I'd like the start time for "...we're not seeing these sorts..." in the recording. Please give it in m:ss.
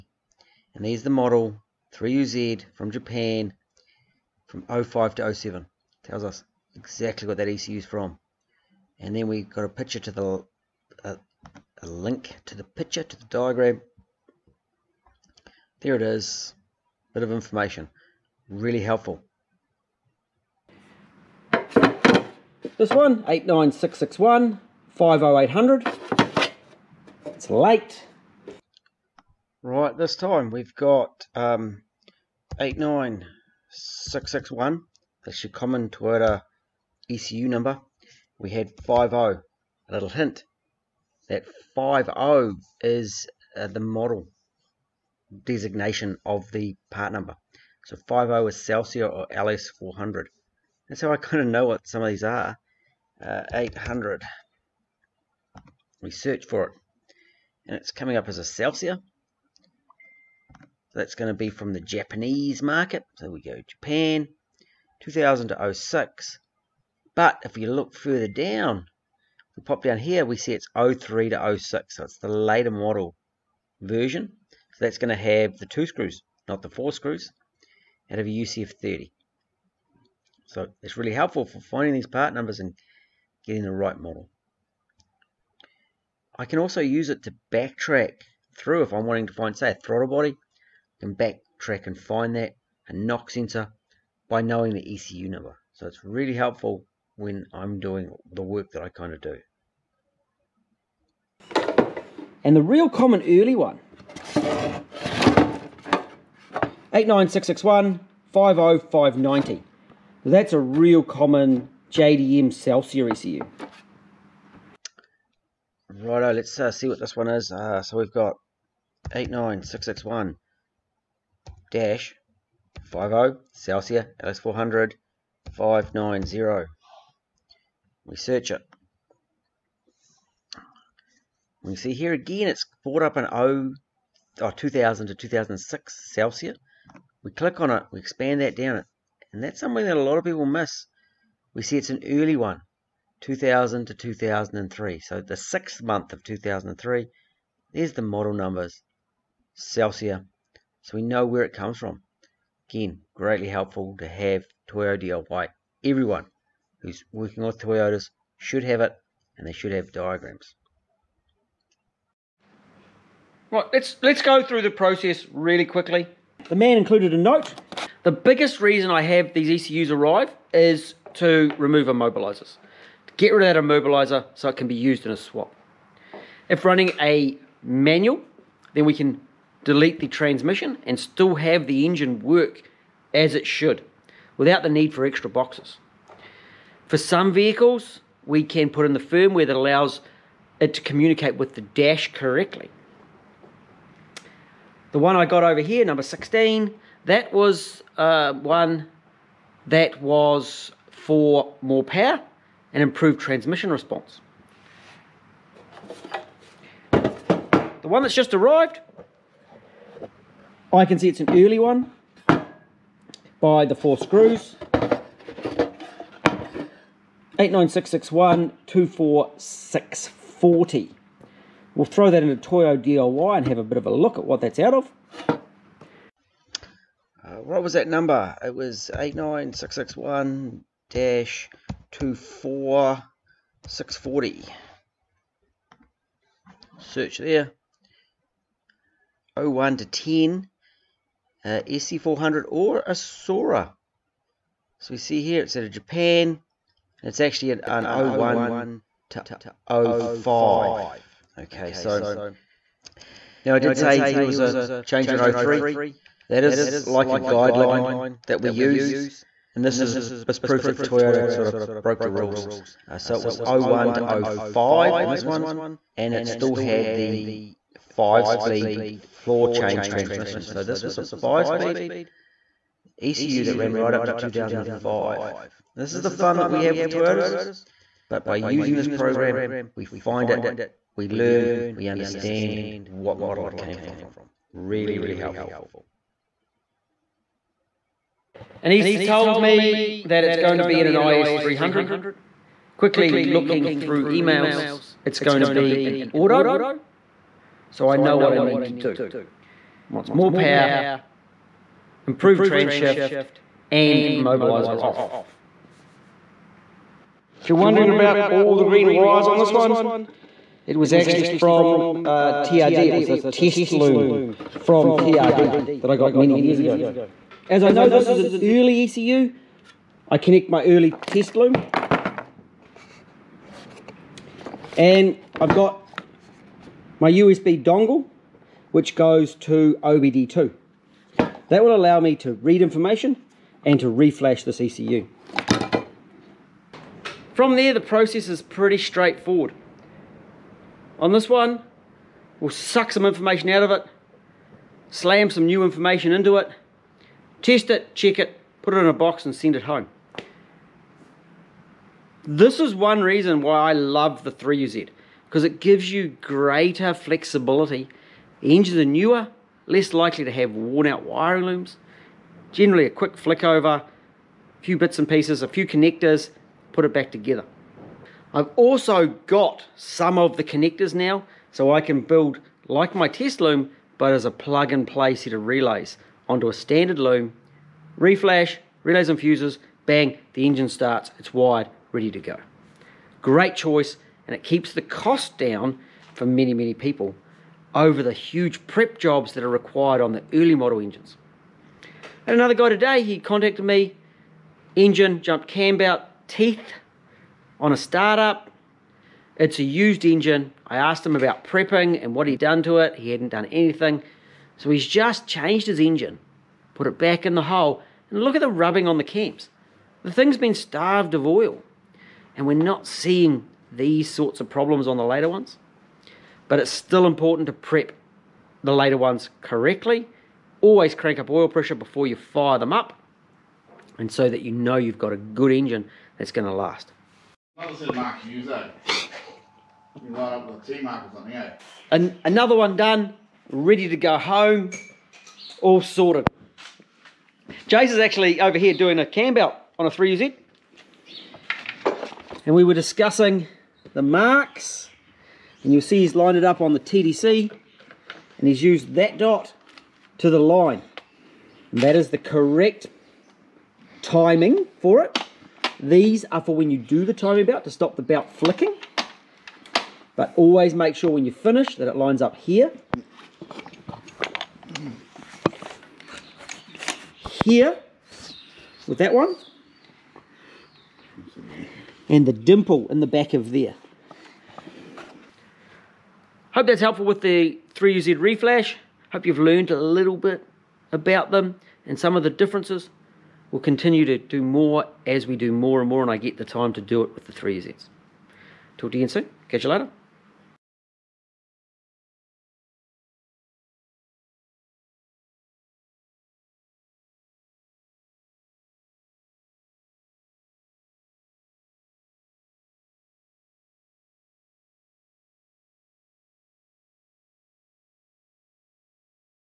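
6:52.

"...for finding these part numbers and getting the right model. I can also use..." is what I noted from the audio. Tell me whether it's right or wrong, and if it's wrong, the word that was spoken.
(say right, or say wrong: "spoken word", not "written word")
right.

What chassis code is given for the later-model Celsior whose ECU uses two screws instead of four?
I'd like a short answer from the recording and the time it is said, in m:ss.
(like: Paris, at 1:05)
UCF 30, at 1:18.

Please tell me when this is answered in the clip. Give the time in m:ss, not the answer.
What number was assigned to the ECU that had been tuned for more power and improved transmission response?
3:15.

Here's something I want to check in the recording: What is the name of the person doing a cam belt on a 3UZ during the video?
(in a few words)
Jace.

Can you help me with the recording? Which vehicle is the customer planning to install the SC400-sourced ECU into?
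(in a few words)
IS300.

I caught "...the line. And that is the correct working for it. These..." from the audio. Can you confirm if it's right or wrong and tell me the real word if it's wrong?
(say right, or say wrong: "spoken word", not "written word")
wrong: "timing", not "working".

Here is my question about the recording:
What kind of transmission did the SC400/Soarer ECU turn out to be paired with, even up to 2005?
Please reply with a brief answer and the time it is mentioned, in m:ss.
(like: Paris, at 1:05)
five-speed floor change, at 4:27.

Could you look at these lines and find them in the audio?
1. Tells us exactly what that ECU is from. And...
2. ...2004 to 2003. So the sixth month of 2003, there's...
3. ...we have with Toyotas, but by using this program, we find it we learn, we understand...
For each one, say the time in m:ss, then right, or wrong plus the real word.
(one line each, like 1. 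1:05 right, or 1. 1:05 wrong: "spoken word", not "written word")
1. 0:06 right
2. 2:23 wrong: "2000", not "2004"
3. 4:36 right.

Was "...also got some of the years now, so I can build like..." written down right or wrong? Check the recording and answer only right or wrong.
wrong.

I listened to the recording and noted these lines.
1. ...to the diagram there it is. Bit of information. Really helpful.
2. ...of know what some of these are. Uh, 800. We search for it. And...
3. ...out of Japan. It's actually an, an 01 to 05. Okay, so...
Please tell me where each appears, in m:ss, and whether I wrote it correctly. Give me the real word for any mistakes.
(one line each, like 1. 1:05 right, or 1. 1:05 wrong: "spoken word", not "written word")
1. 0:13 right
2. 0:51 right
3. 4:05 right.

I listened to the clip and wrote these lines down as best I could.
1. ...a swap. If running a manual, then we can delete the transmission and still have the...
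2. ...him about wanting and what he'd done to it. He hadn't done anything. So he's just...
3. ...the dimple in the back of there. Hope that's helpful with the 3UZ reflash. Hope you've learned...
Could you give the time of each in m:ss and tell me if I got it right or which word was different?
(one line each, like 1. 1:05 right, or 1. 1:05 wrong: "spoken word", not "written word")
1. 2:55 right
2. 6:41 wrong: "prepping", not "wanting"
3. 7:52 right.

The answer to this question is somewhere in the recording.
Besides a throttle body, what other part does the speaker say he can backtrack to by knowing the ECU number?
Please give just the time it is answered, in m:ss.
1:32.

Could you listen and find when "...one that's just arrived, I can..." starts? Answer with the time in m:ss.
3:27.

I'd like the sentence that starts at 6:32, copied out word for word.
And another guy today, he contacted me, engine, jumped cam out, teeth, on a startup.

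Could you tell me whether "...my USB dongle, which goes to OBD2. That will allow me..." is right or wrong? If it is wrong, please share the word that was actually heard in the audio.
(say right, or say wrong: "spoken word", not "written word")
right.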